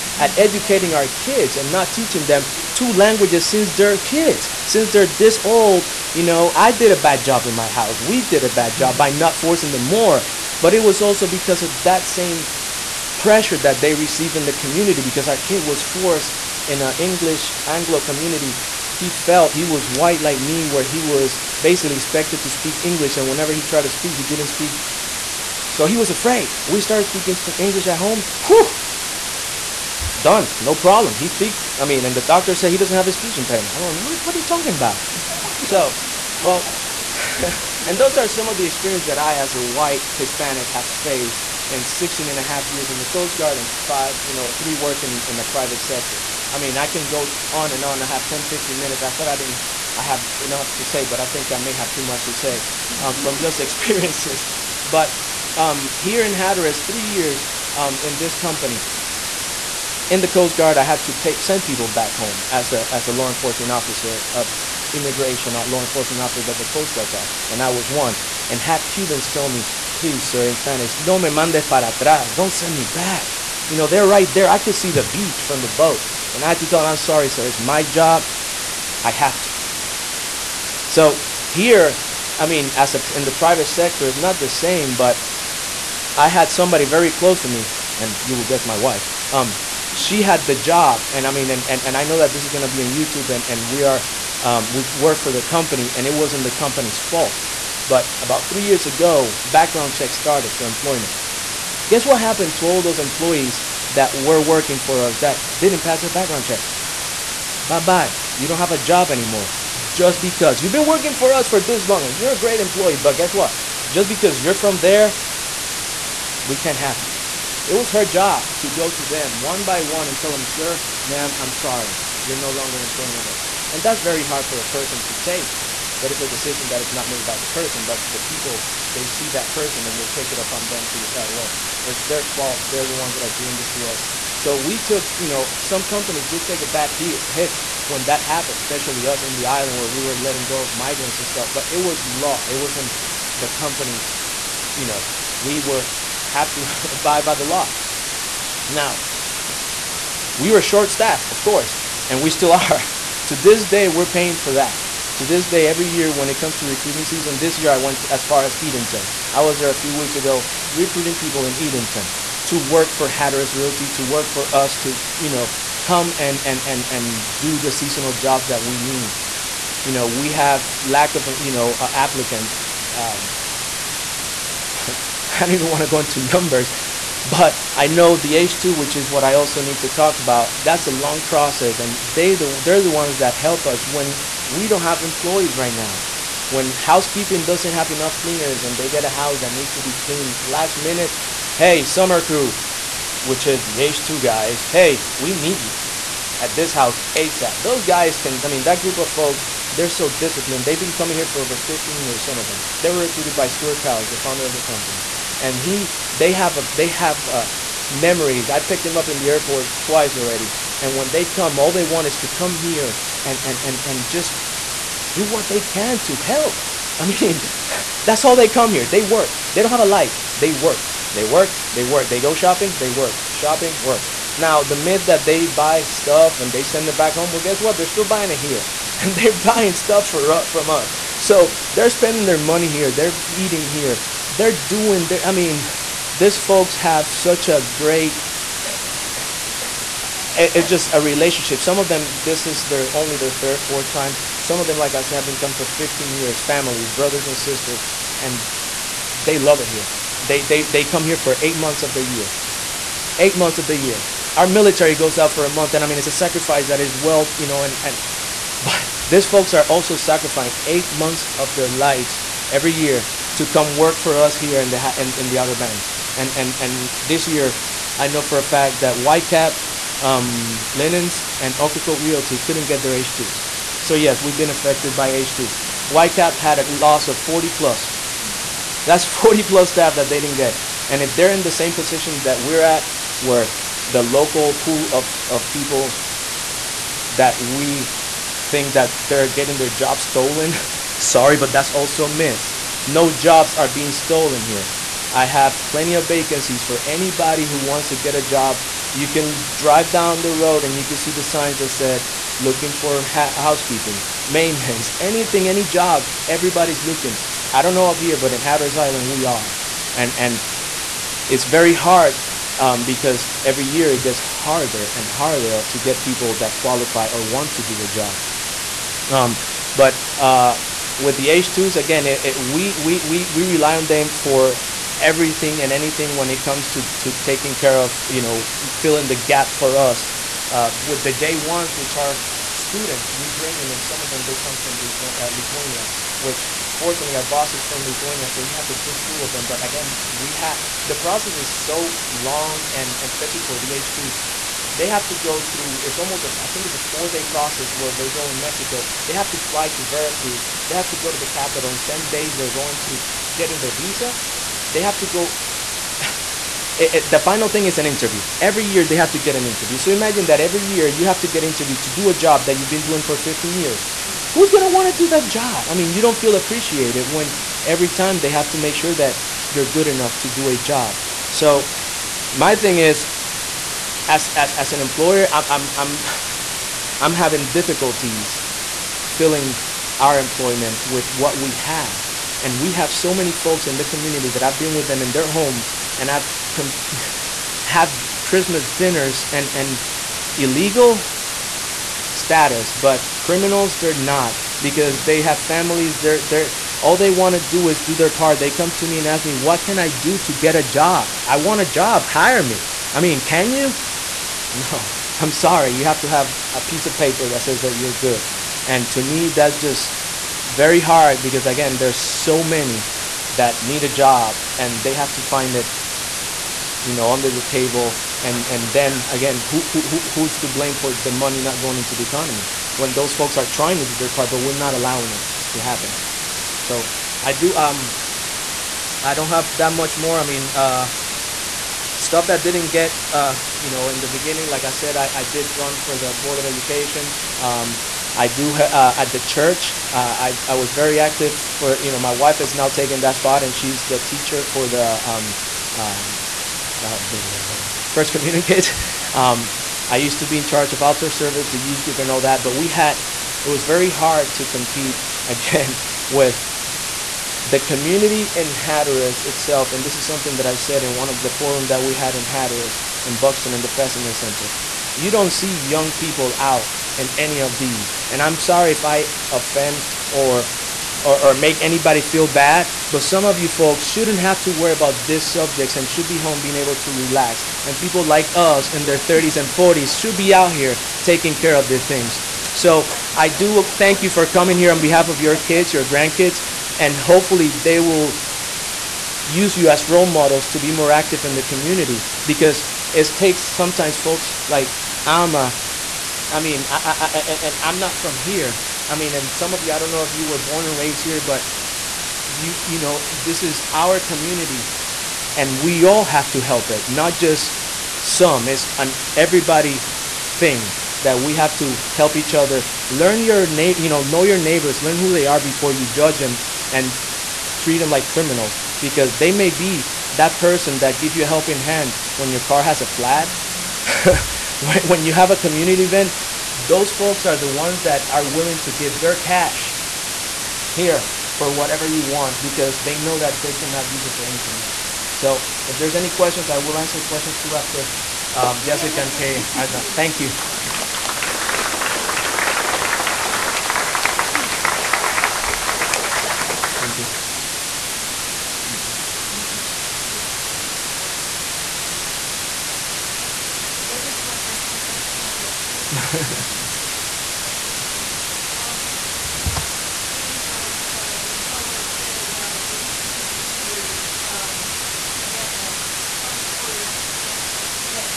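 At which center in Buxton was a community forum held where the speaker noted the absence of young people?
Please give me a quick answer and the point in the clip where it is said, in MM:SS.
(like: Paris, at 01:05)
Fessenden Center, at 07:43.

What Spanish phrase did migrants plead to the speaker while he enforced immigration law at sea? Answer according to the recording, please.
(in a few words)
no me mandes para atrás.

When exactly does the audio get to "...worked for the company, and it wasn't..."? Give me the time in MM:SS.
01:34.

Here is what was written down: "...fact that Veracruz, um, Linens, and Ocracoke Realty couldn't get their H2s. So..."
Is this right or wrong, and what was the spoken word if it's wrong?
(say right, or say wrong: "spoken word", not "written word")
wrong: "Whitecap", not "Veracruz".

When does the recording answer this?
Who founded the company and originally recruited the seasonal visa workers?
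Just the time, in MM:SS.
03:23.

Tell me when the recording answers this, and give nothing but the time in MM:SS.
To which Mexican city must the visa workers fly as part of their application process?
05:49.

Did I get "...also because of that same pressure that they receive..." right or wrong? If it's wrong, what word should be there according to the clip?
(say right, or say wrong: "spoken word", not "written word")
right.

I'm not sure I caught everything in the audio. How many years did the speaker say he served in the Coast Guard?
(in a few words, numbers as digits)
16 and a half years.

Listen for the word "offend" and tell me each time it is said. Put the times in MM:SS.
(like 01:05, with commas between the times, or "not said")
07:49.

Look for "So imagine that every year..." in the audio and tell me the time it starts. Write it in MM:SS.
05:59.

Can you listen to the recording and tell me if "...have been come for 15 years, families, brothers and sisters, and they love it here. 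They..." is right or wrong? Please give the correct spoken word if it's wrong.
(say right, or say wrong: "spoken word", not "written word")
right.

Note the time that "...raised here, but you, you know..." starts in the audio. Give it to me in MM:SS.
08:20.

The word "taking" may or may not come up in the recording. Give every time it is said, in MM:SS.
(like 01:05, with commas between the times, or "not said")
05:27, 08:01.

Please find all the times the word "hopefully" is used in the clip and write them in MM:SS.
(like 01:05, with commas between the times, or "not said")
08:06.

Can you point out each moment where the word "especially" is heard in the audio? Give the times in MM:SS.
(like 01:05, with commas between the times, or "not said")
02:18, 05:43.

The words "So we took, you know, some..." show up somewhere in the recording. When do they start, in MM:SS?
02:14.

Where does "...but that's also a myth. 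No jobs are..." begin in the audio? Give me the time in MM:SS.
04:51.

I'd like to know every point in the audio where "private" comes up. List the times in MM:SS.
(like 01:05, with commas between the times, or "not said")
00:45, 01:23.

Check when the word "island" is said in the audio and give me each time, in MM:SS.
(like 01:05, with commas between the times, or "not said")
02:19, 05:08.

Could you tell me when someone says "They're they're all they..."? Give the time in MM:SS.
06:35.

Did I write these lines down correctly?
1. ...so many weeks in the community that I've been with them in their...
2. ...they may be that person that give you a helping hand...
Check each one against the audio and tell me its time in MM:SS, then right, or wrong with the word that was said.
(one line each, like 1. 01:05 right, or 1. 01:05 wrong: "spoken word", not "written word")
1. 06:22 wrong: "folks", not "weeks"
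2. 08:39 right.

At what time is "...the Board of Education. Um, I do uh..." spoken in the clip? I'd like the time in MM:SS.
07:15.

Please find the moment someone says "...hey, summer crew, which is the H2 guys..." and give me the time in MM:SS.
03:11.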